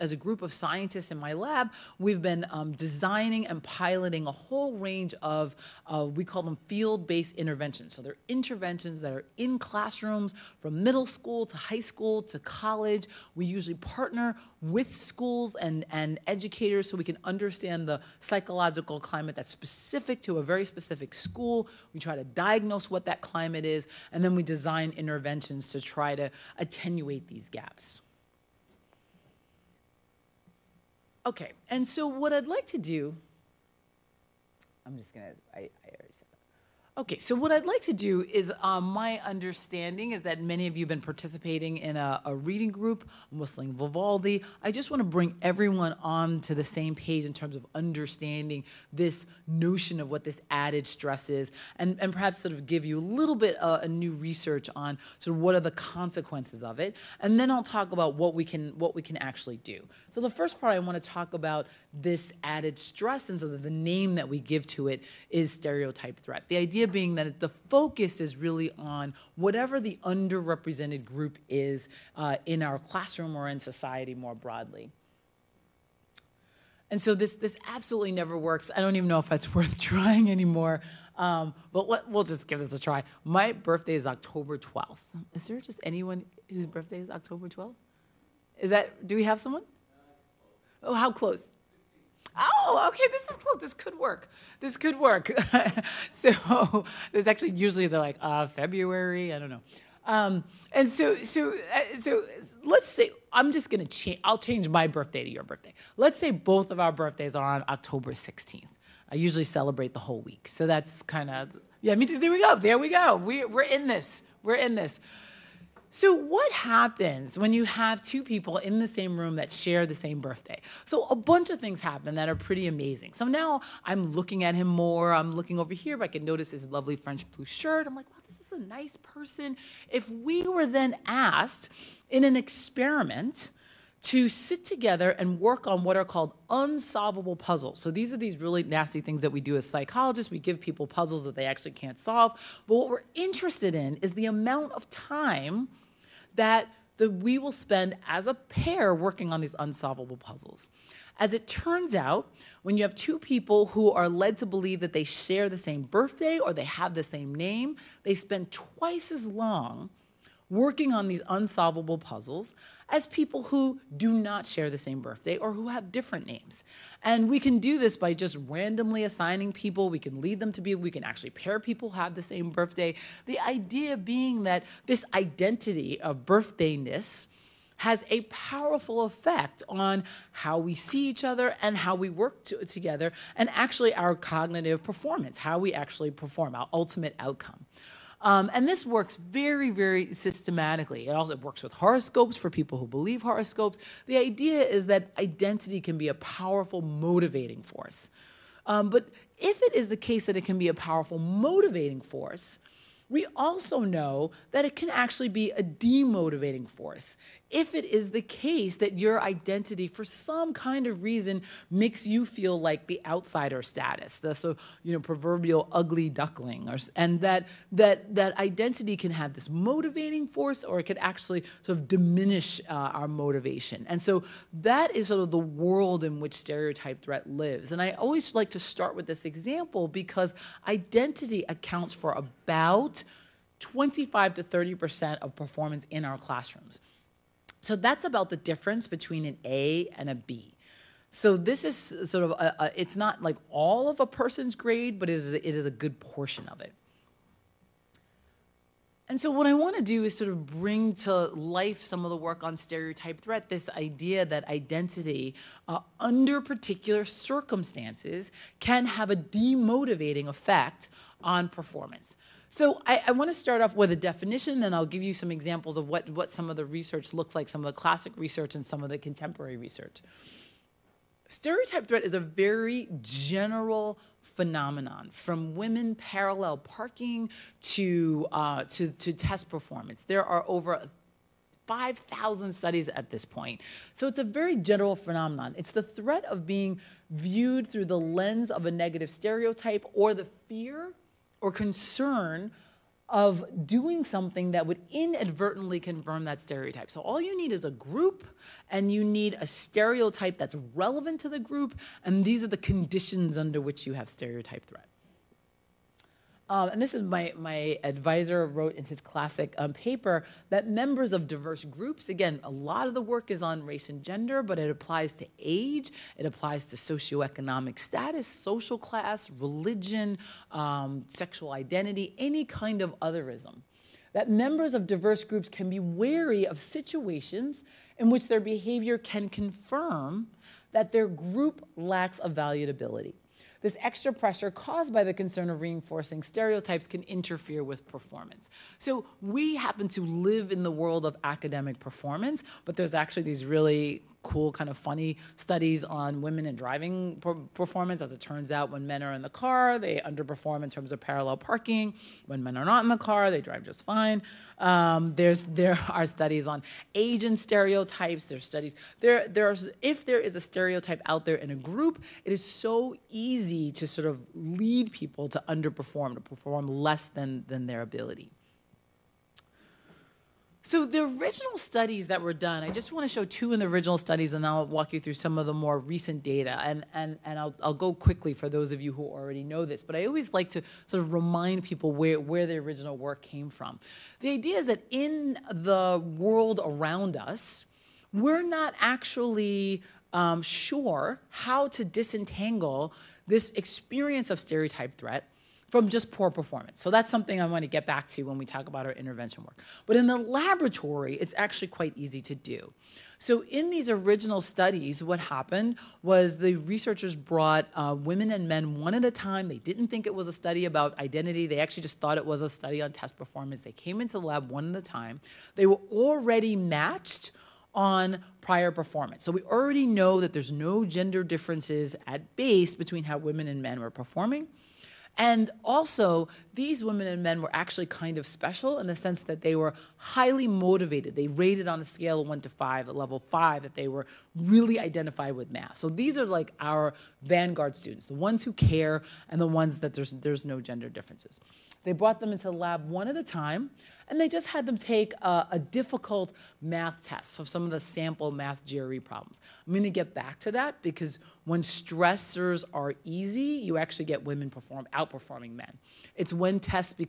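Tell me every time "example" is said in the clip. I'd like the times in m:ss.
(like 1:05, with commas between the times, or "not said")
3:49, 4:25.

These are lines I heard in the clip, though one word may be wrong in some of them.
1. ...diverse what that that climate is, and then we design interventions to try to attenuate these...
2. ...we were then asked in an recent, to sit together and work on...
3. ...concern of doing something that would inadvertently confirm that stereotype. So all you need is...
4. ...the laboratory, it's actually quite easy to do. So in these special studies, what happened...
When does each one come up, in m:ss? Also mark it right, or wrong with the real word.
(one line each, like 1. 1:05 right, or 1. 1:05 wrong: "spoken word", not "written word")
1. 0:22 wrong: "diagnose", not "diverse"
2. 2:10 wrong: "experiment", not "recent"
3. 4:51 right
4. 6:40 wrong: "original", not "special".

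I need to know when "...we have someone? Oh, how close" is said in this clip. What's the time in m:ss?
1:29.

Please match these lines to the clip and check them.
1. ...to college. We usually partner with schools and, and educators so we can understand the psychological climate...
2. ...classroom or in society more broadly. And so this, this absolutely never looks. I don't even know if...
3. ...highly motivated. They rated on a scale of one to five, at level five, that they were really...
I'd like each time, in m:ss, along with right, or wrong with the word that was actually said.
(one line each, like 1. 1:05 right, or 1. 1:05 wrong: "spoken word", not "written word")
1. 0:12 right
2. 1:12 wrong: "works", not "looks"
3. 7:09 right.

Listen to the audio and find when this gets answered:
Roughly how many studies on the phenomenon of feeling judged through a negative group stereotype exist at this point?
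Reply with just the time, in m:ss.
4:40.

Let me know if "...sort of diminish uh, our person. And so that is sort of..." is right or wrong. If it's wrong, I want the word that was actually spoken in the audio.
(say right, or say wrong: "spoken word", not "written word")
wrong: "motivation", not "person".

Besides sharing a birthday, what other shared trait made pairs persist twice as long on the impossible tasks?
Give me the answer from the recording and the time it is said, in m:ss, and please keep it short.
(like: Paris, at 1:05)
the same name, at 2:36.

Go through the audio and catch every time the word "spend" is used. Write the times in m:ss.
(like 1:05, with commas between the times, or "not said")
2:27, 2:38.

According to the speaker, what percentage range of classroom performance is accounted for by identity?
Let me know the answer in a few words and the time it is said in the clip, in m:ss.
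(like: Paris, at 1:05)
25 to 30 percent, at 3:53.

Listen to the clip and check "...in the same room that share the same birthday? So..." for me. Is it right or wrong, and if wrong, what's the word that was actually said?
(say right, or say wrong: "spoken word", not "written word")
right.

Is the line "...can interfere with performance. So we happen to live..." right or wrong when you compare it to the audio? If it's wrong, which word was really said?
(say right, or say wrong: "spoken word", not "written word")
right.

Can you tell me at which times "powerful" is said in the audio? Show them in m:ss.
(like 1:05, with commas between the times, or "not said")
2:58, 3:16, 3:20.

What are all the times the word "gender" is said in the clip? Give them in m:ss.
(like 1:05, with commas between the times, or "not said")
5:14, 7:00, 7:20.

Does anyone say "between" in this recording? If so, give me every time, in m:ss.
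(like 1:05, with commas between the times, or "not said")
3:58, 7:02.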